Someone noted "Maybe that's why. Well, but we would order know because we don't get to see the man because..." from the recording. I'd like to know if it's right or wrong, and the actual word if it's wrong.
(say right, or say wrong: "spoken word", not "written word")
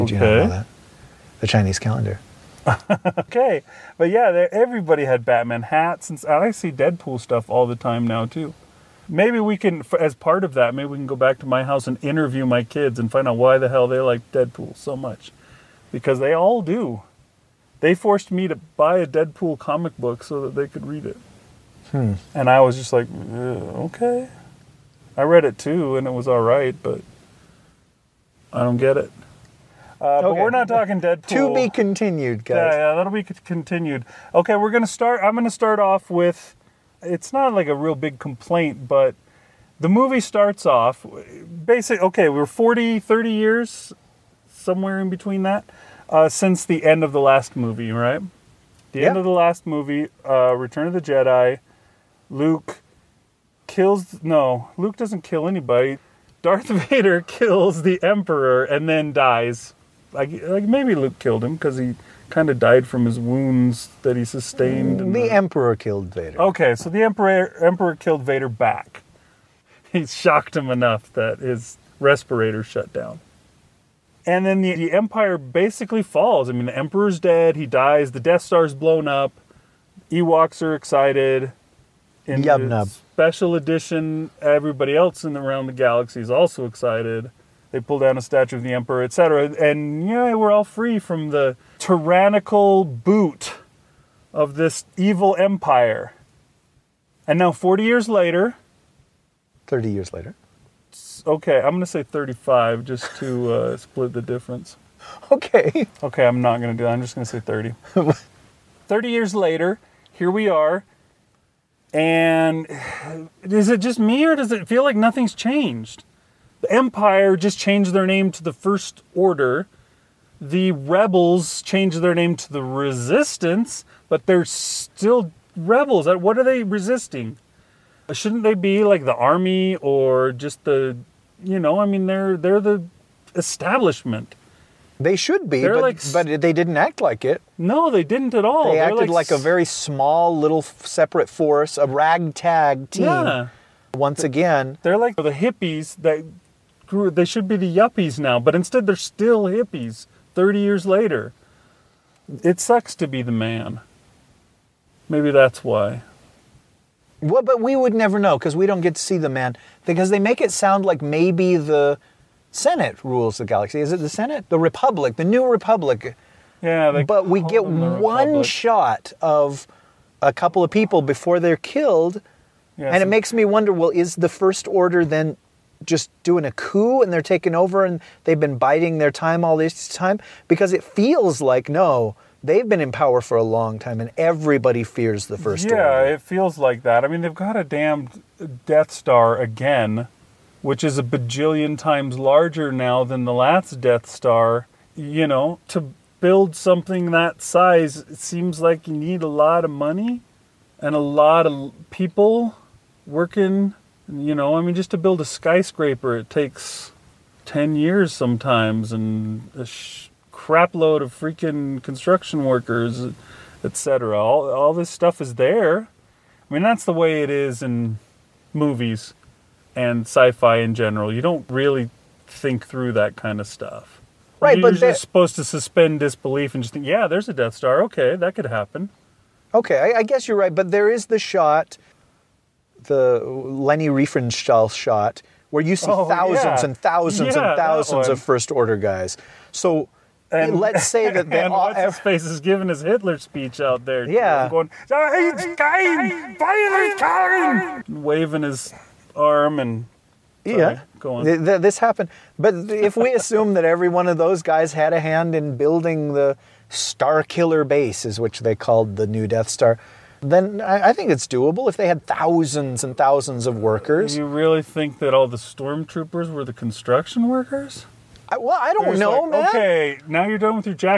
wrong: "never", not "order".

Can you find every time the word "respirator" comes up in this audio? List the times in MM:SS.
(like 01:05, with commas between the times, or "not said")
01:11.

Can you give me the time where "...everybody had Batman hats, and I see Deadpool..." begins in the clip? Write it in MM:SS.
00:04.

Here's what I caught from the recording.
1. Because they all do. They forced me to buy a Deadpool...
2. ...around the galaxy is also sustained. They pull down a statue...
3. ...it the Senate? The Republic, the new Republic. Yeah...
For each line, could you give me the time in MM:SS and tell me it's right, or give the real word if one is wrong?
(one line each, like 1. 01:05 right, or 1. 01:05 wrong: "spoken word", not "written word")
1. 00:15 right
2. 01:25 wrong: "excited", not "sustained"
3. 02:43 right.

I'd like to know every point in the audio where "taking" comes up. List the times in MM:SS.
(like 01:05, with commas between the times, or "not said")
02:57.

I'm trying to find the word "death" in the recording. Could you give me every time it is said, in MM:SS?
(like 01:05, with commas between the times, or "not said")
01:18, 03:08, 03:13, 03:47, 04:19.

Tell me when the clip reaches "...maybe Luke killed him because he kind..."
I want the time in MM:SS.
01:00.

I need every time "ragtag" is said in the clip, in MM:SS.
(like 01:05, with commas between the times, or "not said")
02:21.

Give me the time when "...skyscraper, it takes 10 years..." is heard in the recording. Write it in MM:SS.
03:25.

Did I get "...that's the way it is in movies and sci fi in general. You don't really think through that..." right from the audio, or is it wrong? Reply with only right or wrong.
right.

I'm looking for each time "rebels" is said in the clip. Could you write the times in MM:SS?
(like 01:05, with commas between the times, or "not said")
02:00, 02:05.